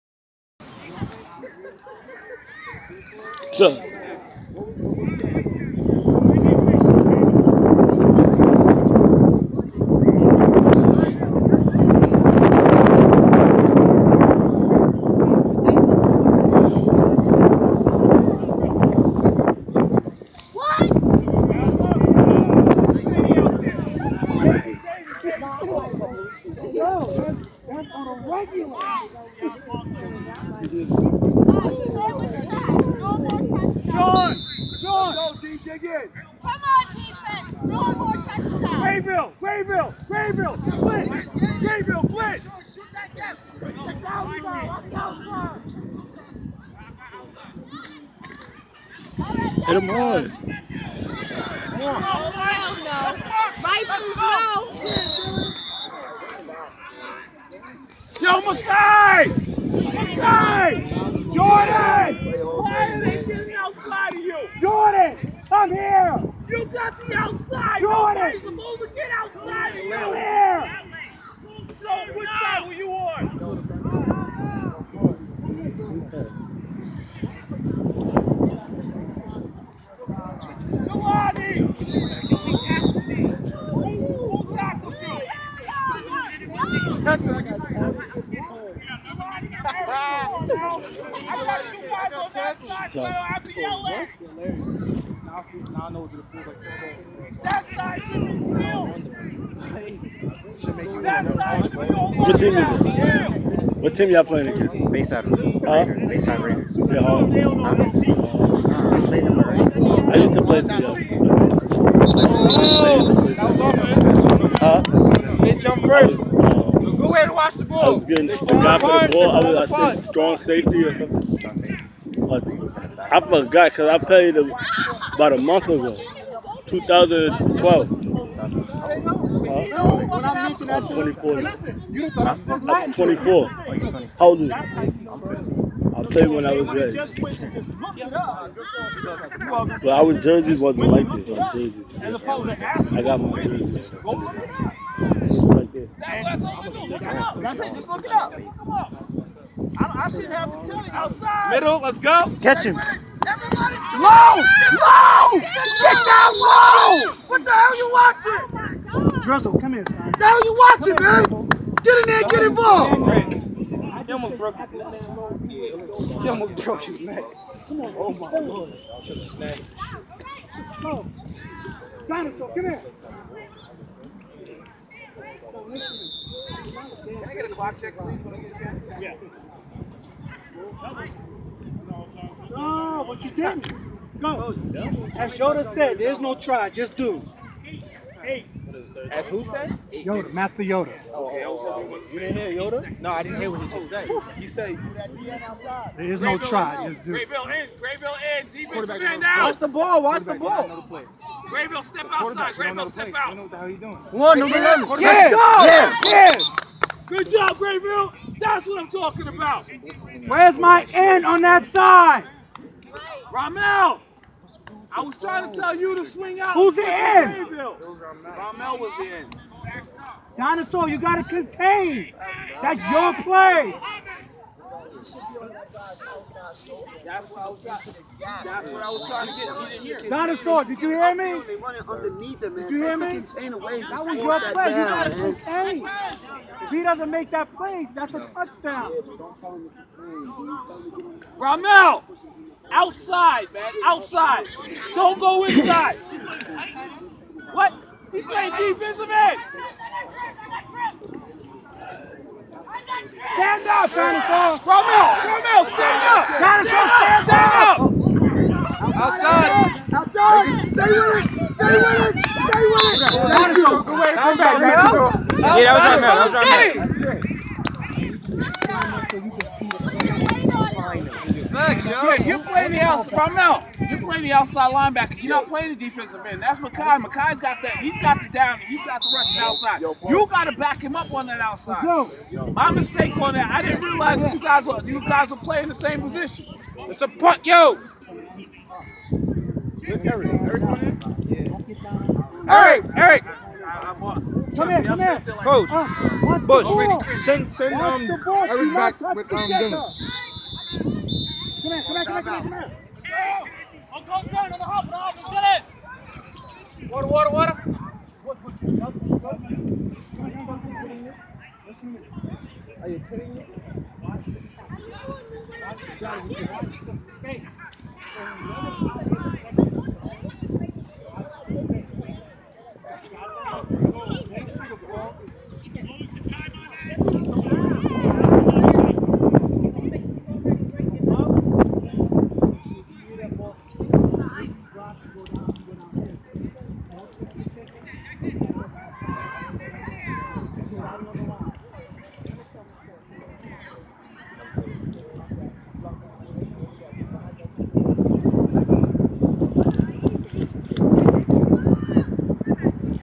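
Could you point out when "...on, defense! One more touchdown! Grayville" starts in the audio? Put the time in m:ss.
0:36.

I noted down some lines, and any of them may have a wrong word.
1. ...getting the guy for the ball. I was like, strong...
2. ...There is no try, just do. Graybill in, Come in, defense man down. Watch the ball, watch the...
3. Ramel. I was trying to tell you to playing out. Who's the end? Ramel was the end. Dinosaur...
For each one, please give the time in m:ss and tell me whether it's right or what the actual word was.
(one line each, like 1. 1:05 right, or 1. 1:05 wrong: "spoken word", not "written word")
1. 1:58 right
2. 3:15 wrong: "Graybill", not "Come"
3. 3:33 wrong: "swing", not "playing".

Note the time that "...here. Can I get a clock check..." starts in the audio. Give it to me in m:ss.
2:52.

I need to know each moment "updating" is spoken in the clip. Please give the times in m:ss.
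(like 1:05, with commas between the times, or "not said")
not said.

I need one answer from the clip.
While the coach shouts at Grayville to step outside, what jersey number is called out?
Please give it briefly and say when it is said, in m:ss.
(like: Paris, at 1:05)
11, at 3:24.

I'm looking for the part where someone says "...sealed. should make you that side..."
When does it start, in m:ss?
1:38.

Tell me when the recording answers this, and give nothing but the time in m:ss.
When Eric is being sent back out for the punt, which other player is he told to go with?
4:59.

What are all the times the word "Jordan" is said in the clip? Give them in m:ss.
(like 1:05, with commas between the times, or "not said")
1:01, 1:07.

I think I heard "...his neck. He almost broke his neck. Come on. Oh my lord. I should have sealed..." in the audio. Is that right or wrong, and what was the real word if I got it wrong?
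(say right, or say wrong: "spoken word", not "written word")
wrong: "snatched", not "sealed".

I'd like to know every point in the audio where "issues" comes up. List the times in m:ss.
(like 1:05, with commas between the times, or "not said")
not said.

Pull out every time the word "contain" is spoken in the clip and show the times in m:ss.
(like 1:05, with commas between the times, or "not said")
3:41, 3:55.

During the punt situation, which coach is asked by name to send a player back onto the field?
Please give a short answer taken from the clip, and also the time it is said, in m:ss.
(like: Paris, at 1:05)
Bush, at 4:56.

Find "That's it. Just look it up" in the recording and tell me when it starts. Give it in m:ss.
2:25.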